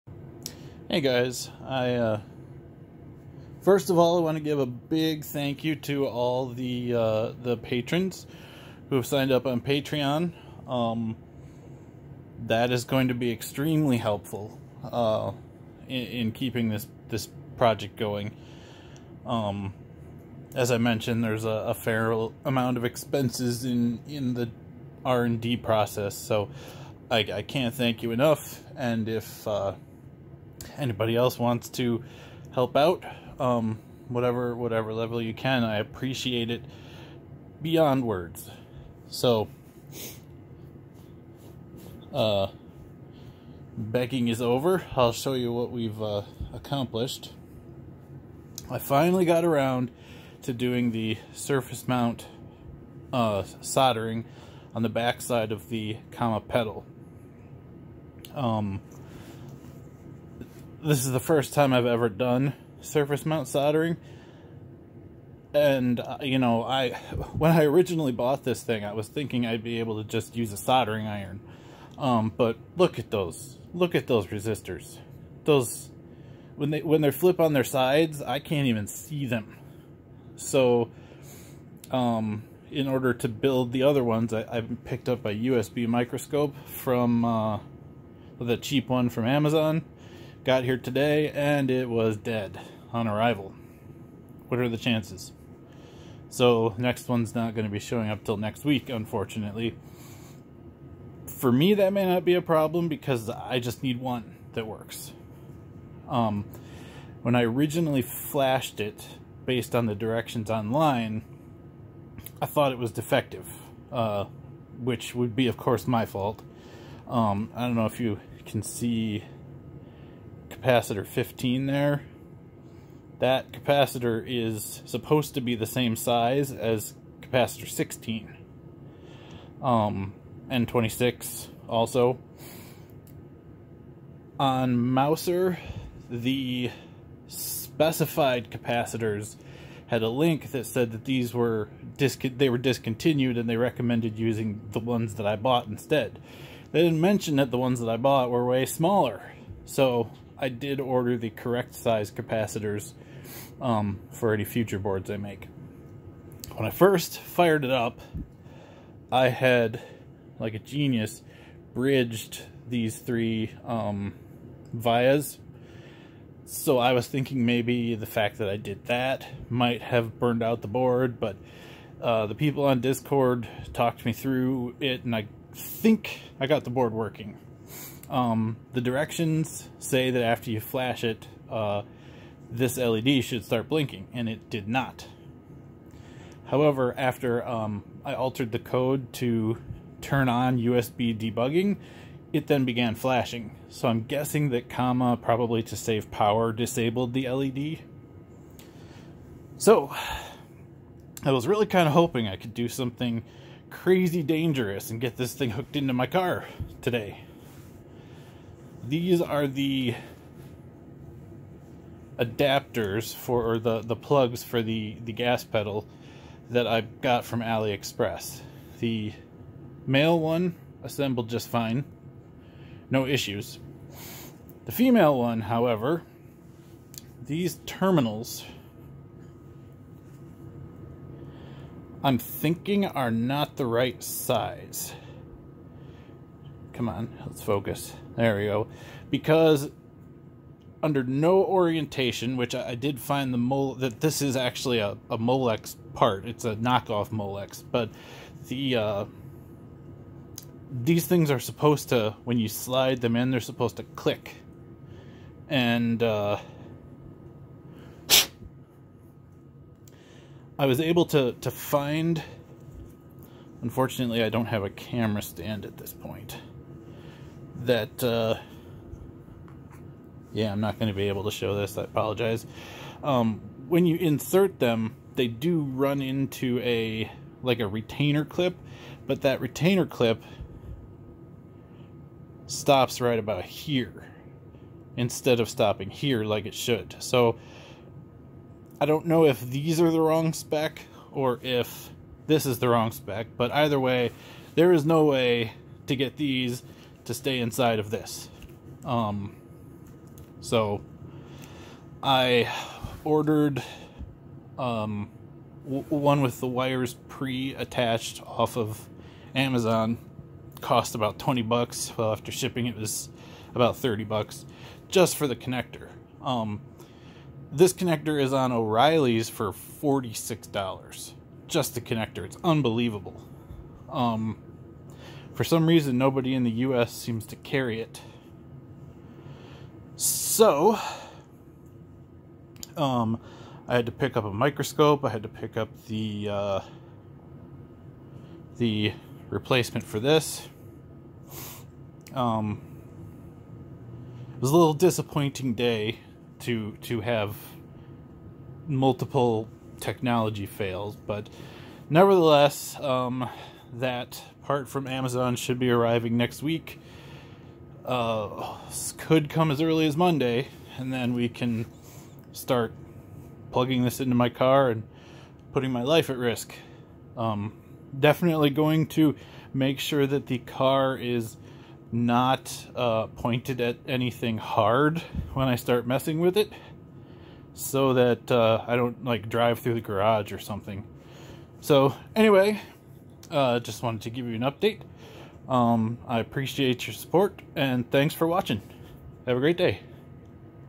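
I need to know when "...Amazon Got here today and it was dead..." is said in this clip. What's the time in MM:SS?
01:29.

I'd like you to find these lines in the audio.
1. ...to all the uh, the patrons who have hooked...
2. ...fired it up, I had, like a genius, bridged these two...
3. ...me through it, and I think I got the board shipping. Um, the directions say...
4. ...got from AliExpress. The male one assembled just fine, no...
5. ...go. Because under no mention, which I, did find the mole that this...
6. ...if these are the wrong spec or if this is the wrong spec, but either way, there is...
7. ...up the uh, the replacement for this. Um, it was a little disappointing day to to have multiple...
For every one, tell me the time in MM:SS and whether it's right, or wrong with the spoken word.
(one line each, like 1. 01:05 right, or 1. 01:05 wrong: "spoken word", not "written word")
1. 00:05 wrong: "signed", not "hooked"
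2. 02:37 wrong: "three", not "two"
3. 02:54 wrong: "working", not "shipping"
4. 03:36 right
5. 03:58 wrong: "orientation", not "mention"
6. 04:49 right
7. 05:35 right.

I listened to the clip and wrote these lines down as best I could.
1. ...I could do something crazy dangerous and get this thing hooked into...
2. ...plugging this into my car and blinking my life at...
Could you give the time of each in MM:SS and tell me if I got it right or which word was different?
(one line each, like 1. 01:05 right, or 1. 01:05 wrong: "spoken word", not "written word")
1. 03:22 right
2. 06:03 wrong: "putting", not "blinking".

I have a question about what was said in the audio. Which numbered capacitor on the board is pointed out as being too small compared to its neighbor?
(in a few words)
15.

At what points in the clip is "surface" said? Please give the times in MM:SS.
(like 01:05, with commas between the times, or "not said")
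00:51, 01:02.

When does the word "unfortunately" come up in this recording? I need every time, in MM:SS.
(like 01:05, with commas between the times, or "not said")
01:38, 04:23.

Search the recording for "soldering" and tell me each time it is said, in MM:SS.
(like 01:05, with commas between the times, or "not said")
00:53, 01:03, 01:10.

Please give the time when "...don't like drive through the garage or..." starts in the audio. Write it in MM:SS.
06:18.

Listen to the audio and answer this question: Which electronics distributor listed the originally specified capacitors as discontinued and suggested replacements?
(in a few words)
Mouser.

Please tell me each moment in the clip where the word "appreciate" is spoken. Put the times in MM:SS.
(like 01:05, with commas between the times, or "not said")
00:35, 06:26.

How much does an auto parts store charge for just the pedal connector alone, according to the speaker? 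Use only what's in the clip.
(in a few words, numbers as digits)
$46.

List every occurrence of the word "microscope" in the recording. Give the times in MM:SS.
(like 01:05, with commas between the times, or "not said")
01:25, 05:34.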